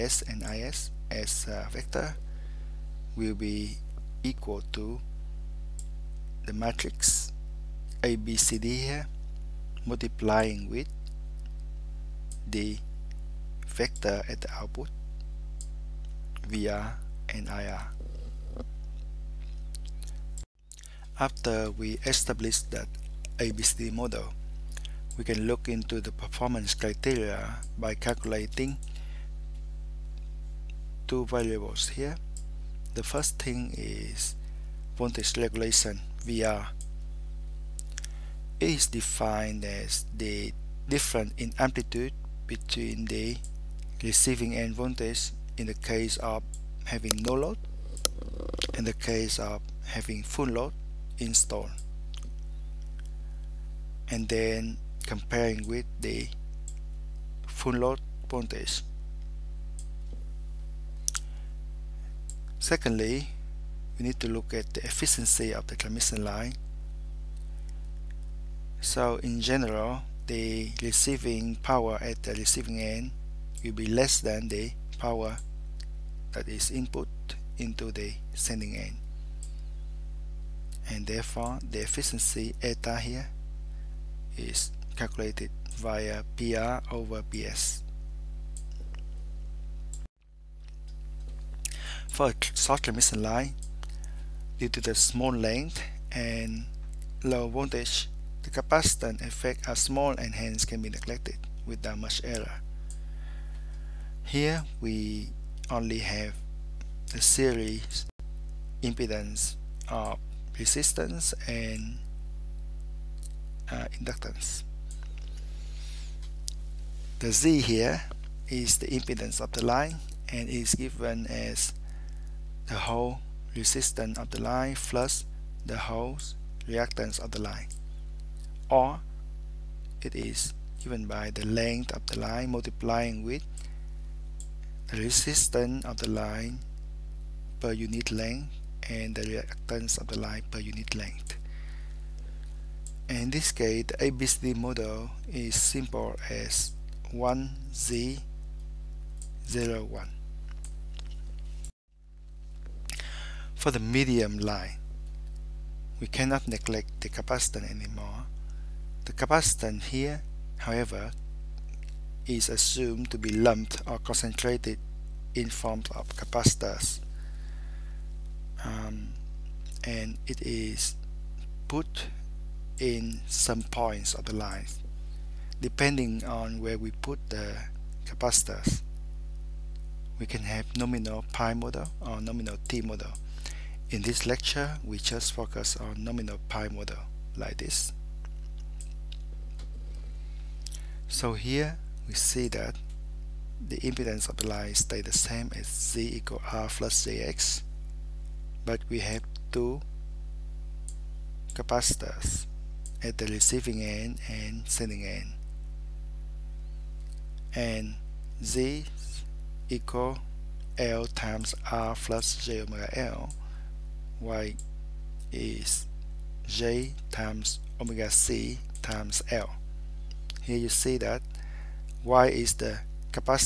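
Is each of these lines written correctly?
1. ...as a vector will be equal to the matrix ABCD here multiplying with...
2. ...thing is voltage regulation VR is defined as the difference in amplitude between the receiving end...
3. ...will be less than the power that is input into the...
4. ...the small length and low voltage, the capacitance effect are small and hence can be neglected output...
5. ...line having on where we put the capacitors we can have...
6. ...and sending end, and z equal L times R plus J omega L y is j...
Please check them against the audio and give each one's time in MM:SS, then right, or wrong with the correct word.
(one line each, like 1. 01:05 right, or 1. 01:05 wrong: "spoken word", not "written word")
1. 00:01 right
2. 00:33 right
3. 01:13 right
4. 01:34 wrong: "without", not "output"
5. 02:54 wrong: "depending", not "having"
6. 03:24 right.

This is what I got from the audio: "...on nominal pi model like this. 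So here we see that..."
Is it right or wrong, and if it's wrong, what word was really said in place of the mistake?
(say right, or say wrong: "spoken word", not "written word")
right.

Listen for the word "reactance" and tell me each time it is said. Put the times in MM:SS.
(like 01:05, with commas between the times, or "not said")
02:06, 02:19.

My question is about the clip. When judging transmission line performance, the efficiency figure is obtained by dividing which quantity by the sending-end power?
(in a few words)
PR.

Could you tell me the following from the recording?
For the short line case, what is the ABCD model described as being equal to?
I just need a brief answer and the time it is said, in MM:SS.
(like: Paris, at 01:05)
1Z01, at 02:27.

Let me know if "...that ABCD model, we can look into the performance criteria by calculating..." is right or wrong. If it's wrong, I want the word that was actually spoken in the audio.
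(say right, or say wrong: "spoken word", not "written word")
right.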